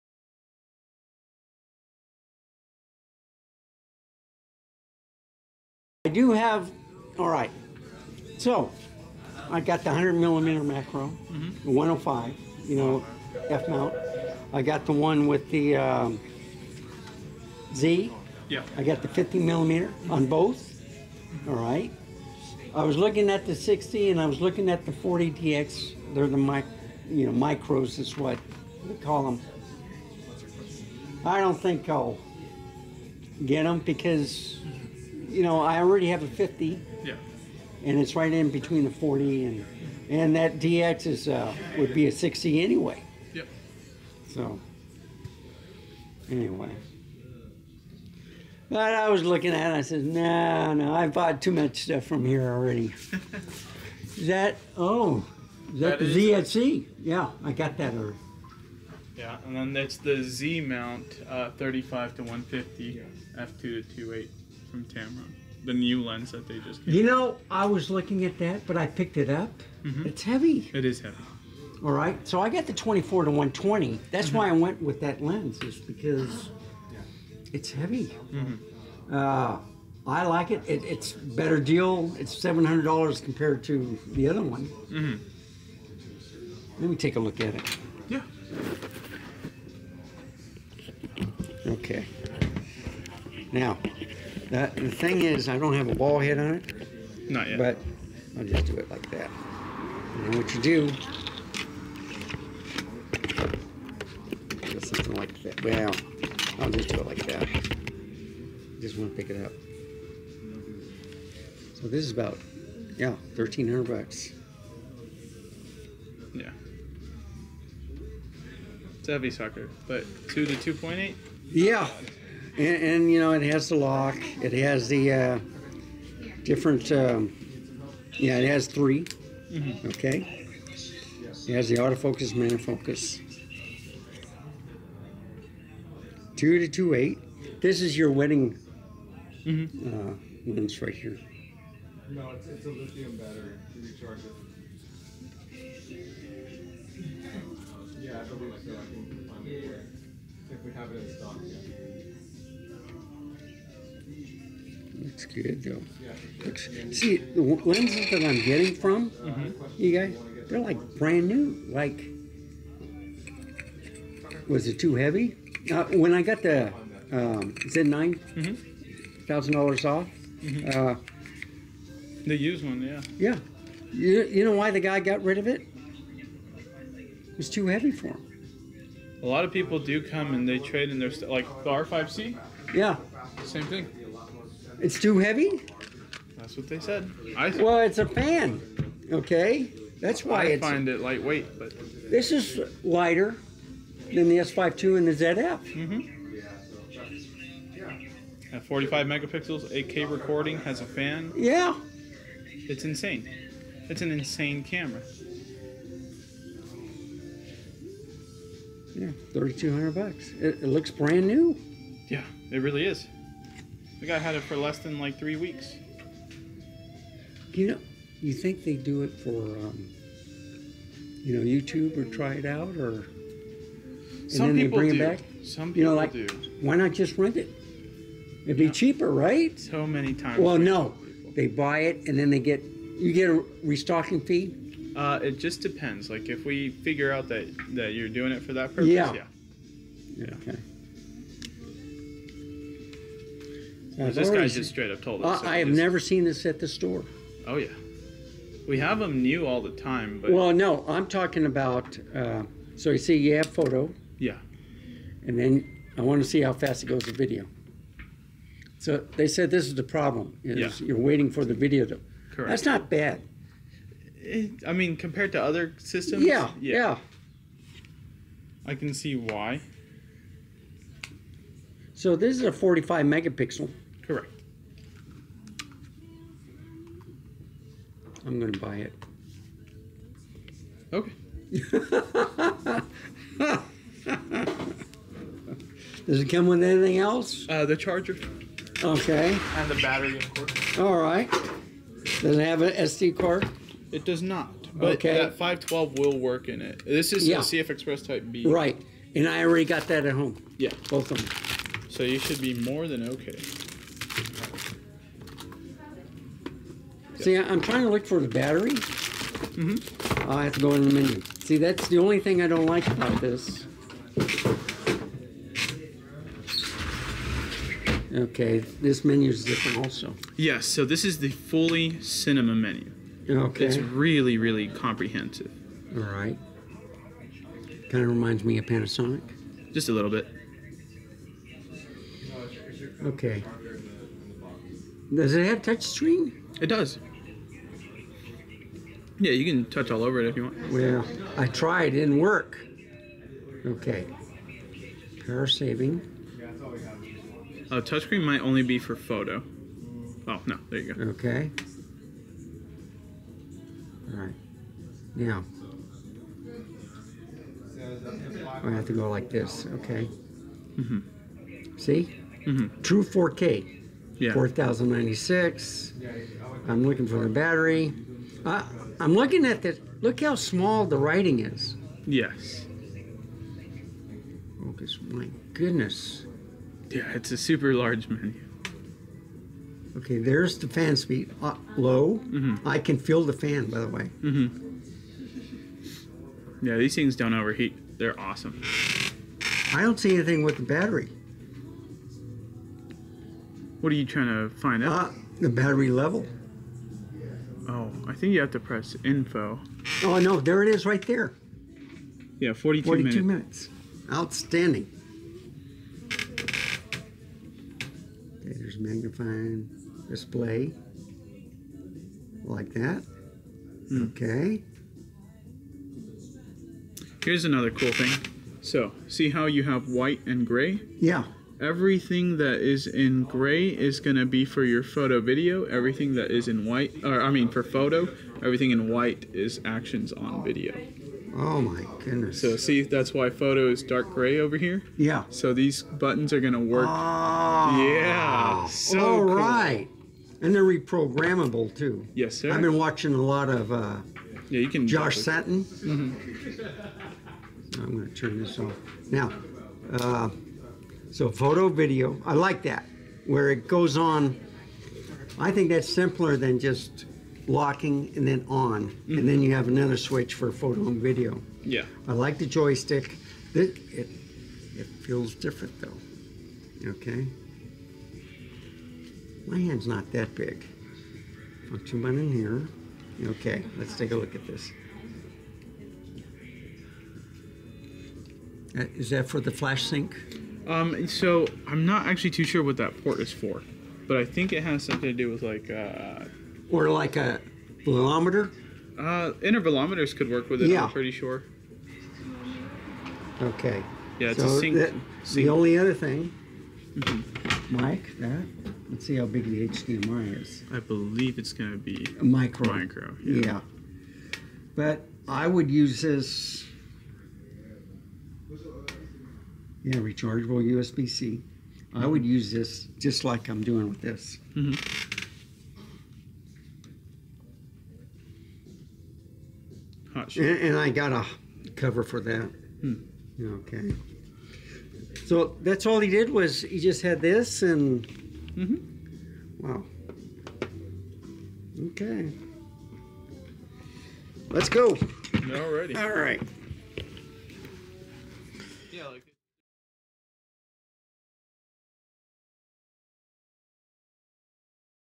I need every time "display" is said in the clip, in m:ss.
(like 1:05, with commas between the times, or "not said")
6:50.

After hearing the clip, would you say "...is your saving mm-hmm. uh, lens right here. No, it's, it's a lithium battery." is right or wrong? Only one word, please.
wrong.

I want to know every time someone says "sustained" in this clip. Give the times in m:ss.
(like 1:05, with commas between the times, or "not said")
not said.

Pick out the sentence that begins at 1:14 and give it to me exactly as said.
why I went with that lens, is because it's heavy.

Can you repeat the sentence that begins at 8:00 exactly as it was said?
Um, so I'm not actually too sure what that port is for, but I think it has something to do with like.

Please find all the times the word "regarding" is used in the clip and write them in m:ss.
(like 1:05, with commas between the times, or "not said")
not said.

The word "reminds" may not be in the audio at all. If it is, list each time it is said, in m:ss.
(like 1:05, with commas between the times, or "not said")
5:28.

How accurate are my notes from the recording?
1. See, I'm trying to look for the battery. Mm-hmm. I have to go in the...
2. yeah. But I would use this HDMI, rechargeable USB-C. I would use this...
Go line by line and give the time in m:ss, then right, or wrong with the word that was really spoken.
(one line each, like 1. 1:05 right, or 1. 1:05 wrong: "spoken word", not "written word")
1. 5:07 right
2. 8:23 wrong: "Yeah", not "HDMI".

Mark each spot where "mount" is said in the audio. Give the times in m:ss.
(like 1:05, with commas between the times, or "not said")
0:13, 1:00.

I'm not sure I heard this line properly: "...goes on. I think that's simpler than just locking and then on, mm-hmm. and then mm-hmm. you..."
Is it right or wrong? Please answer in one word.
right.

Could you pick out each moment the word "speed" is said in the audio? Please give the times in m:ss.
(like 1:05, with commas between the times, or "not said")
6:20.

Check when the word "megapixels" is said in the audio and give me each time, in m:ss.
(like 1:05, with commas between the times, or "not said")
3:19, 4:33.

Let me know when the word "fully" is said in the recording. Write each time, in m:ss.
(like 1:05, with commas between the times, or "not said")
5:21.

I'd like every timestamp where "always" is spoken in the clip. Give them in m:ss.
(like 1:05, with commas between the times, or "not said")
not said.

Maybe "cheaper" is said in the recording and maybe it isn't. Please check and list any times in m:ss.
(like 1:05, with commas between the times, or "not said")
3:48.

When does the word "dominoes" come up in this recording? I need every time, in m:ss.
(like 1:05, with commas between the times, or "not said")
not said.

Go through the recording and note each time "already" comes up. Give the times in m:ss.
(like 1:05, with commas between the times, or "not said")
0:35, 0:52, 0:57, 4:59.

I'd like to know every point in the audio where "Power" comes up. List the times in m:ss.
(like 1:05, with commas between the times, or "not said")
5:45.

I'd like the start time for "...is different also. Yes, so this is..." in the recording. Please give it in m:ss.
5:19.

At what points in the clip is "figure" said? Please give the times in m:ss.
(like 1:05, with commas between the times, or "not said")
3:56.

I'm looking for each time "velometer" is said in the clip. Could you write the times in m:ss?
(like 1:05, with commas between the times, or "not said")
8:07.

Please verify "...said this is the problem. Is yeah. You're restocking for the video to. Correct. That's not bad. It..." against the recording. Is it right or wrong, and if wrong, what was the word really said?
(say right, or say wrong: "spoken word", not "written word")
wrong: "waiting", not "restocking".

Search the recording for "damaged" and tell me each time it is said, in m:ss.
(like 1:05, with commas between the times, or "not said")
not said.